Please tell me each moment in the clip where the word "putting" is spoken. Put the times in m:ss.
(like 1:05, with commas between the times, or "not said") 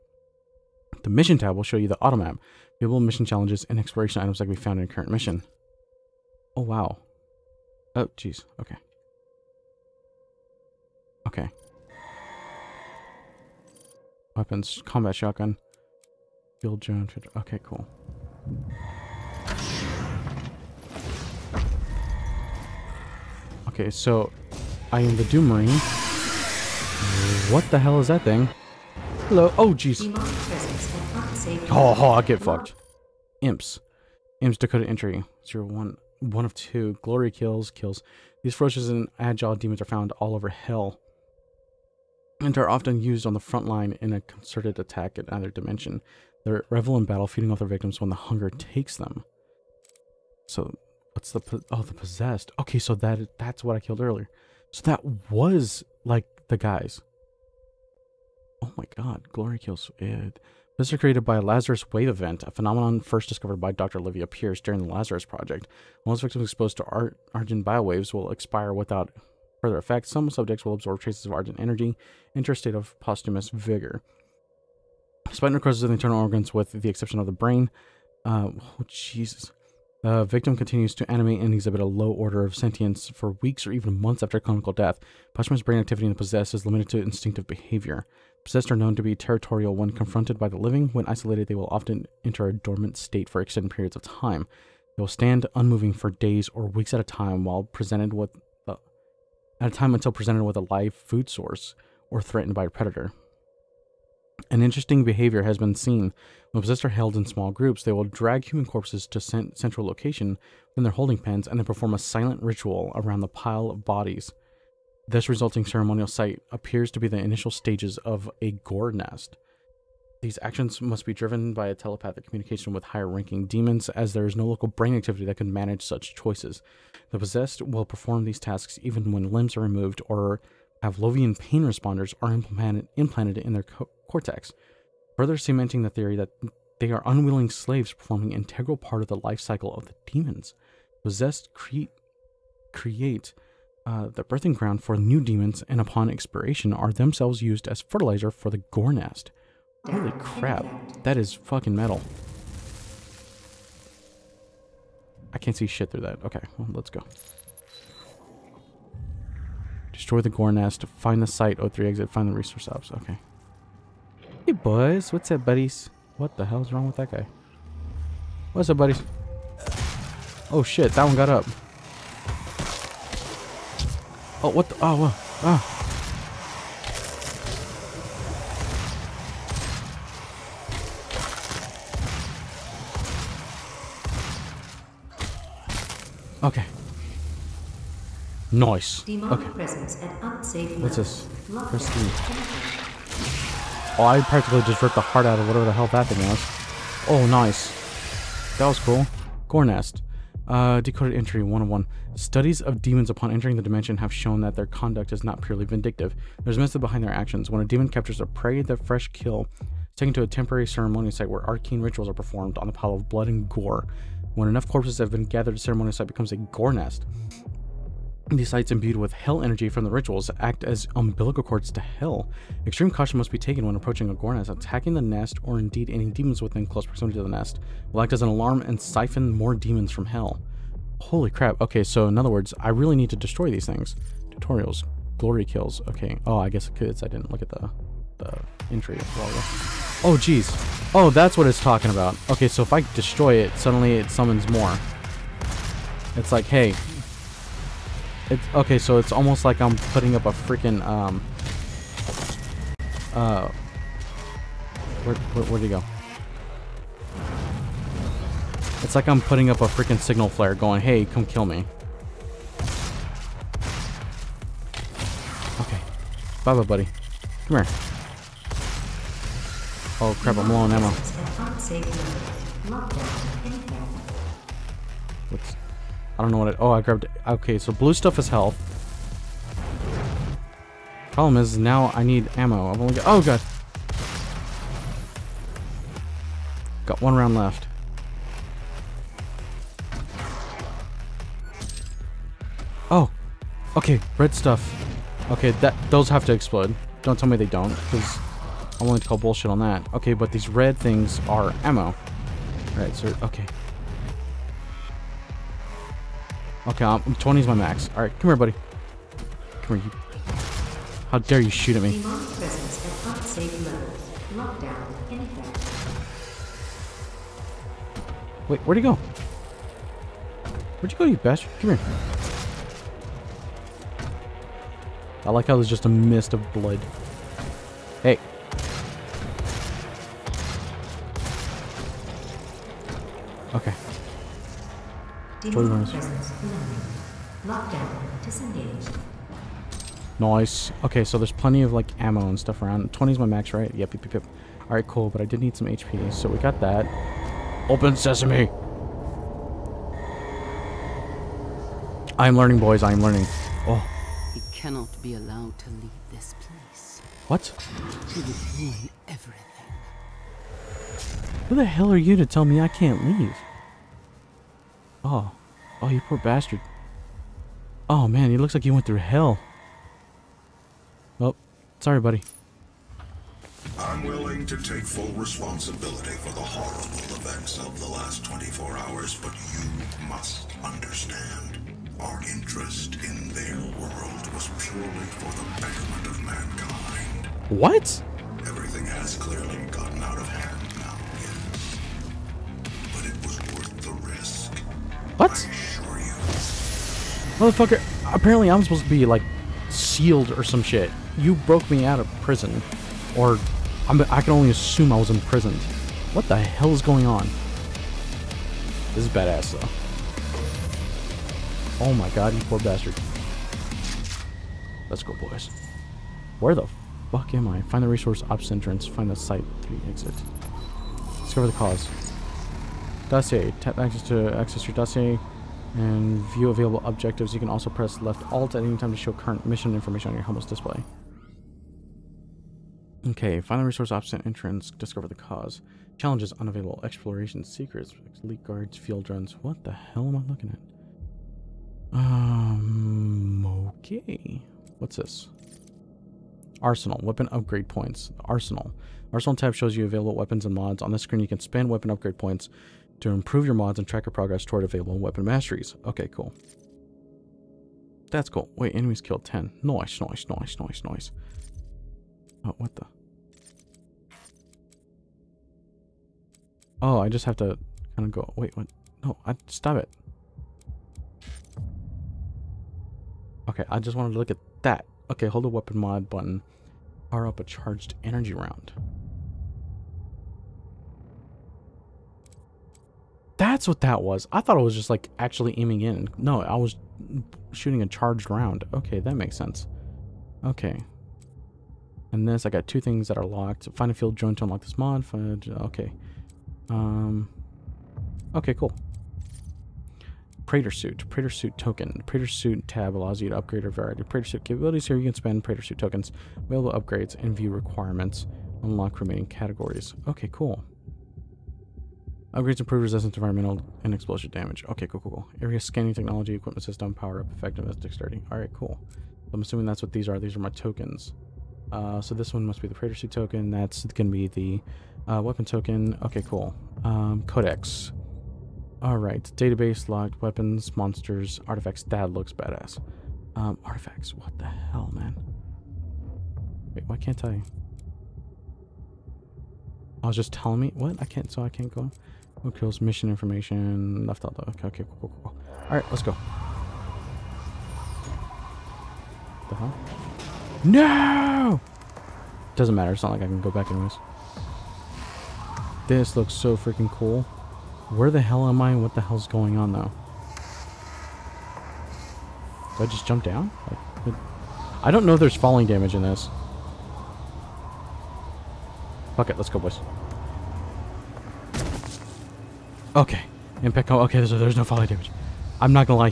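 4:09, 4:19.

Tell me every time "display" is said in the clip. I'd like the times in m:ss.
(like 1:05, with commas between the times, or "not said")
7:10.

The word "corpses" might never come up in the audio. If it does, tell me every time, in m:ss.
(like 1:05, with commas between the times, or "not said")
1:48, 3:34.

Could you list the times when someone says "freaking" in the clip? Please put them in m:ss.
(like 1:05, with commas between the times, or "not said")
4:10, 4:19, 9:16.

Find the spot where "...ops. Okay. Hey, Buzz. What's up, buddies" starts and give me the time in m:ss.
2:42.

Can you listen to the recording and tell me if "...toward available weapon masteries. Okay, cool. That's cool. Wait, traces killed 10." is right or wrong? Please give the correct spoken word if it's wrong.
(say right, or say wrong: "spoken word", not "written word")
wrong: "enemies", not "traces".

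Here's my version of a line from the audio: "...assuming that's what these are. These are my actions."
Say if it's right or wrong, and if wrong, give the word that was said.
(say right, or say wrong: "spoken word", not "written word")
wrong: "tokens", not "actions".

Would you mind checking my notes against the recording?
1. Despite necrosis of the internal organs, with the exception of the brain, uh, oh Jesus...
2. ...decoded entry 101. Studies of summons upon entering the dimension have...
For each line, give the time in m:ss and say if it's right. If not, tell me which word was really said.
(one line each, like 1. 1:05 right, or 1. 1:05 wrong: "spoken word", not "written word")
1. 1:15 right
2. 3:20 wrong: "demons", not "summons".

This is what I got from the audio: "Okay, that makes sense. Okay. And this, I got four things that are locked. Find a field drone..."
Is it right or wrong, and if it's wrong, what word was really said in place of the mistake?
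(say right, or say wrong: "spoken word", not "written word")
wrong: "two", not "four".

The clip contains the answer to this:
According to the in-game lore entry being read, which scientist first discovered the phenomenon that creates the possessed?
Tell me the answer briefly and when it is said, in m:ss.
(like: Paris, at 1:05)
Dr. Olivia Pierce, at 1:03.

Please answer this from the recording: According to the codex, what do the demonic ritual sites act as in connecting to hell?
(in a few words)
Umbilical cords.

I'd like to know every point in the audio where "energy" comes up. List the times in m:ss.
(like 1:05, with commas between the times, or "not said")
1:11, 3:39, 7:58.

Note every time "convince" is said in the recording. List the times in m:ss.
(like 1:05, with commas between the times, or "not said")
not said.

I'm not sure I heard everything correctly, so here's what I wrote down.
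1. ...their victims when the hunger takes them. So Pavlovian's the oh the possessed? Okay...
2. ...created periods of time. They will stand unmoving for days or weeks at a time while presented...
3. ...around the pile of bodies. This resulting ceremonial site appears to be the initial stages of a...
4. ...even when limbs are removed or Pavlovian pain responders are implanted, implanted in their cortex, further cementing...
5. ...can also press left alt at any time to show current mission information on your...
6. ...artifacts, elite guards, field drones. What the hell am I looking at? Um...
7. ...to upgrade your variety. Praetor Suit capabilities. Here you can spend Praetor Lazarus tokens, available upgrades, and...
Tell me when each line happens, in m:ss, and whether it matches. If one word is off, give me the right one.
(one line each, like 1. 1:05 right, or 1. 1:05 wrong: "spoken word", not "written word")
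1. 0:47 wrong: "What", not "Pavlovian"
2. 1:33 wrong: "extended", not "created"
3. 1:52 right
4. 2:08 right
5. 7:07 right
6. 7:17 wrong: "secrets", not "artifacts"
7. 8:23 wrong: "Suit", not "Lazarus".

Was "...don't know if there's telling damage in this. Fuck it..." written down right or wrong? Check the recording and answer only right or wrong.
wrong.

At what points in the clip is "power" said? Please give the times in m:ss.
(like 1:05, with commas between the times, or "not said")
7:57, 8:36.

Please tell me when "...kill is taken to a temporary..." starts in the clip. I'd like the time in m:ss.
3:29.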